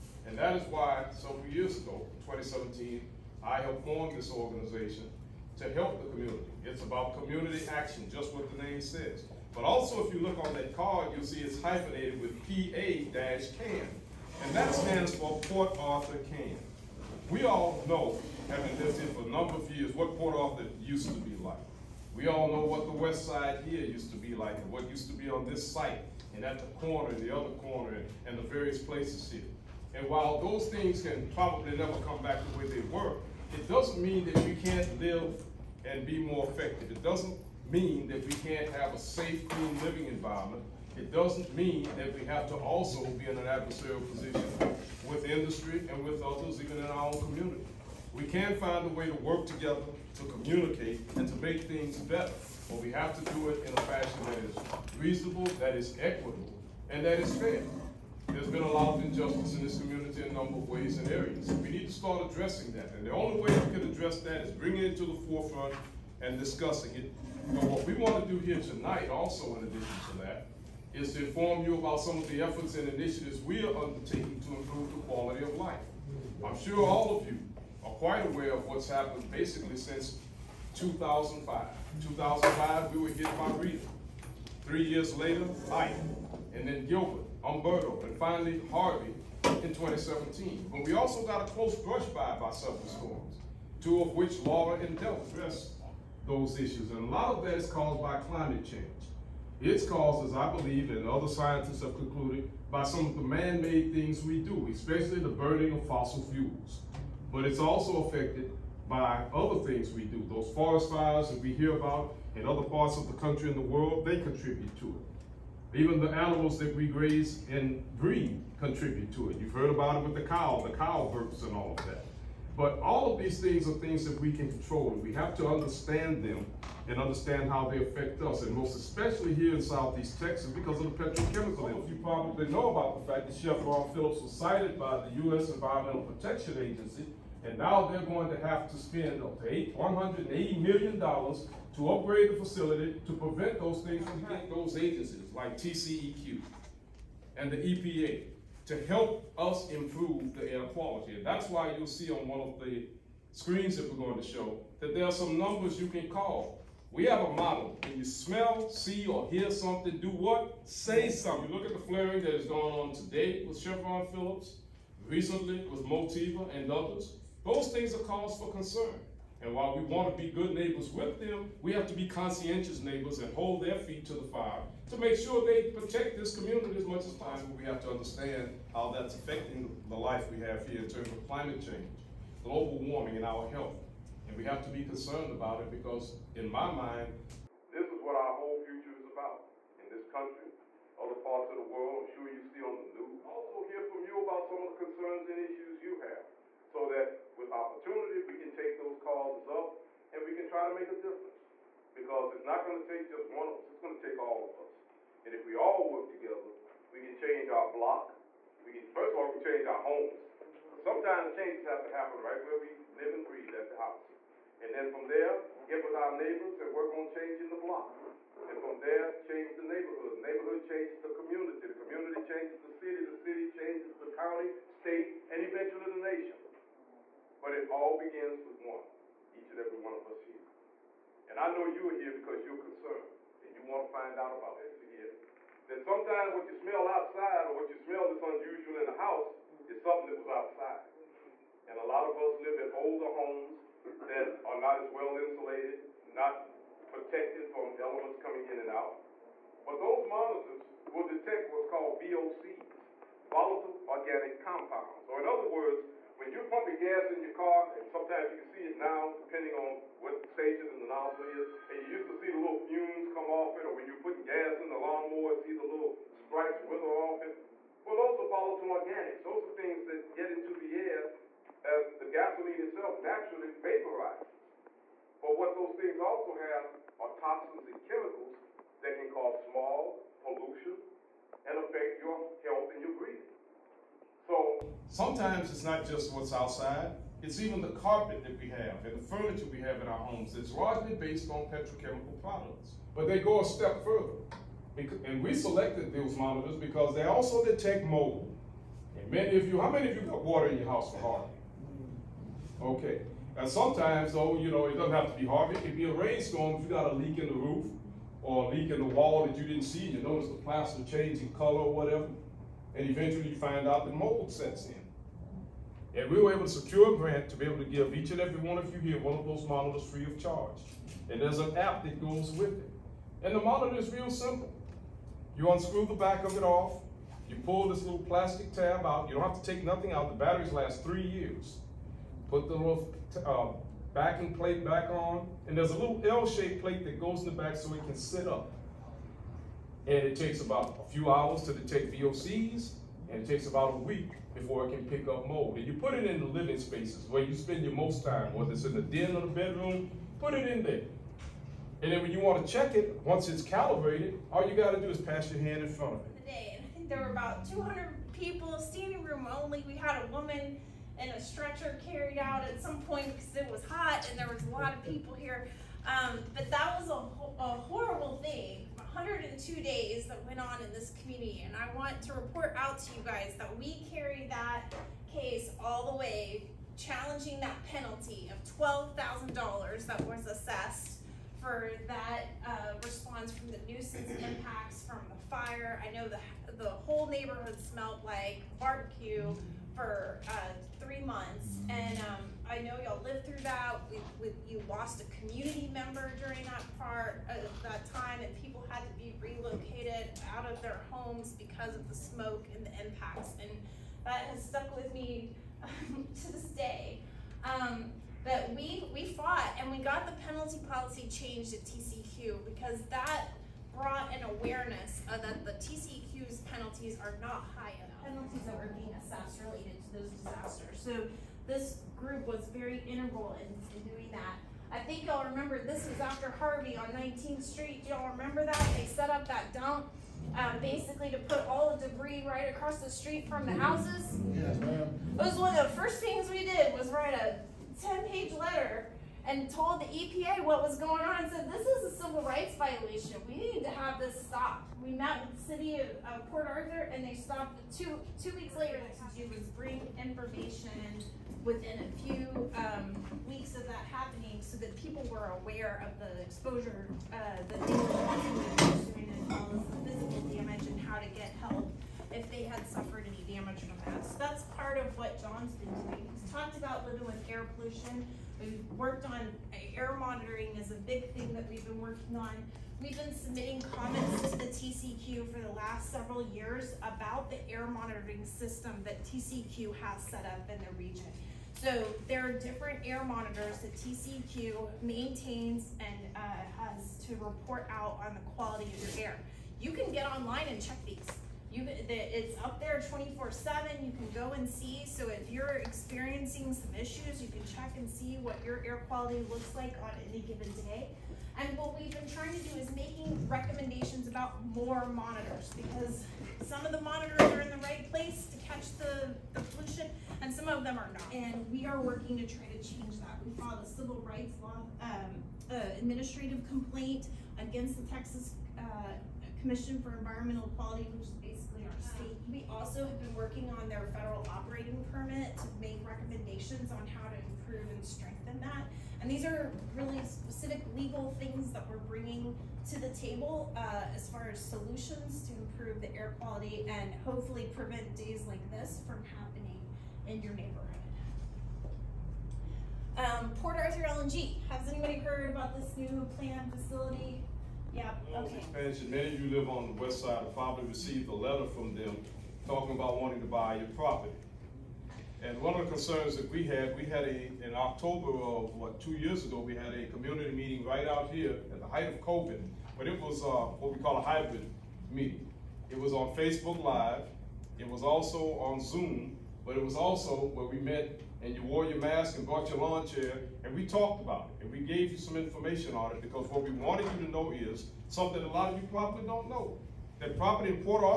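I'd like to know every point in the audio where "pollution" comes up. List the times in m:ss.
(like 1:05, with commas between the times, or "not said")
4:40, 7:47, 8:29.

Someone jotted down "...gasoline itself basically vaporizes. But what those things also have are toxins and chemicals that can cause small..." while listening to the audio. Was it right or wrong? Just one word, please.
wrong.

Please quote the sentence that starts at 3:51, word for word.
And I know you're here because you're concerned and you want to find out about it.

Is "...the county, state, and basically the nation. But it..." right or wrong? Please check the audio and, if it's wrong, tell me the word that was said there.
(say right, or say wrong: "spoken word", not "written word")
wrong: "eventually", not "basically".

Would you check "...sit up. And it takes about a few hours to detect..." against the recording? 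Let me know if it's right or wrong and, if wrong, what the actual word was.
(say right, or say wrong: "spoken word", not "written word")
right.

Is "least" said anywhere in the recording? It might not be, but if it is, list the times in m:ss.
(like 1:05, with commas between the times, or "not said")
not said.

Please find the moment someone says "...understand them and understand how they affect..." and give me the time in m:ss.
2:05.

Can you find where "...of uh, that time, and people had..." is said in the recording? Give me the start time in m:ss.
6:37.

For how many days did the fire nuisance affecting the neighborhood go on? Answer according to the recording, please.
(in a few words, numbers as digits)
102.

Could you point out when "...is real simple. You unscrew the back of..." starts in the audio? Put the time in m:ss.
5:23.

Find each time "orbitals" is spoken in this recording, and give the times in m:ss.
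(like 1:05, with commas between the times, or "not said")
not said.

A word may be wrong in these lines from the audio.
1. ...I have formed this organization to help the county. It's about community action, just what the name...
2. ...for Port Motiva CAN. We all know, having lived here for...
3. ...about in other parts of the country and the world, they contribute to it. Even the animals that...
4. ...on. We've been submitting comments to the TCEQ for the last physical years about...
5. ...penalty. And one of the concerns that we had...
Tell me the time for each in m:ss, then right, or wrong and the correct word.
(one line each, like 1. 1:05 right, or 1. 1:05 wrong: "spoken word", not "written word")
1. 0:03 wrong: "community", not "county"
2. 0:15 wrong: "Arthur", not "Motiva"
3. 1:51 right
4. 7:52 wrong: "several", not "physical"
5. 9:13 wrong: "property", not "penalty".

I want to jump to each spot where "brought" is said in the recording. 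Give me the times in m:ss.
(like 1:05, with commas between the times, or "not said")
6:53, 9:32.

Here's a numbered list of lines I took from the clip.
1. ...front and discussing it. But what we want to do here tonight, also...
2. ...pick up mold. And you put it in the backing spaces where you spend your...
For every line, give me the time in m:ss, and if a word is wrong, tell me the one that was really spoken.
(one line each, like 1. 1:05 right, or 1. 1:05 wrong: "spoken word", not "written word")
1. 1:05 wrong: "forefront", not "front"
2. 5:44 wrong: "living", not "backing".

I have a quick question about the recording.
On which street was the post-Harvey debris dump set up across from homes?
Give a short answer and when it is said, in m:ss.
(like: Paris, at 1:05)
19th Street, at 7:06.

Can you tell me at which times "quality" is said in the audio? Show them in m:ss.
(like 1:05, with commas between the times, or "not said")
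1:15, 2:30, 8:08, 8:18, 8:40, 8:56.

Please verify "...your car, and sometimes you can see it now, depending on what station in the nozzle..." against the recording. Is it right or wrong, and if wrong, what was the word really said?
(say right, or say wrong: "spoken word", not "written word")
right.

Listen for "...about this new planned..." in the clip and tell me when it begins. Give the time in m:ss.
9:05.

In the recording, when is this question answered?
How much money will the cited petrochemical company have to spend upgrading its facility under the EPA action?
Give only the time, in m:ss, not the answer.
2:19.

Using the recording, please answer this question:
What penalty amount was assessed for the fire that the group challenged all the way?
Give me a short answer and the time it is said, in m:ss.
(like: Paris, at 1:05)
$12,000, at 6:18.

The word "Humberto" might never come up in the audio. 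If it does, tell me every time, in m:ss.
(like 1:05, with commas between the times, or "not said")
1:27.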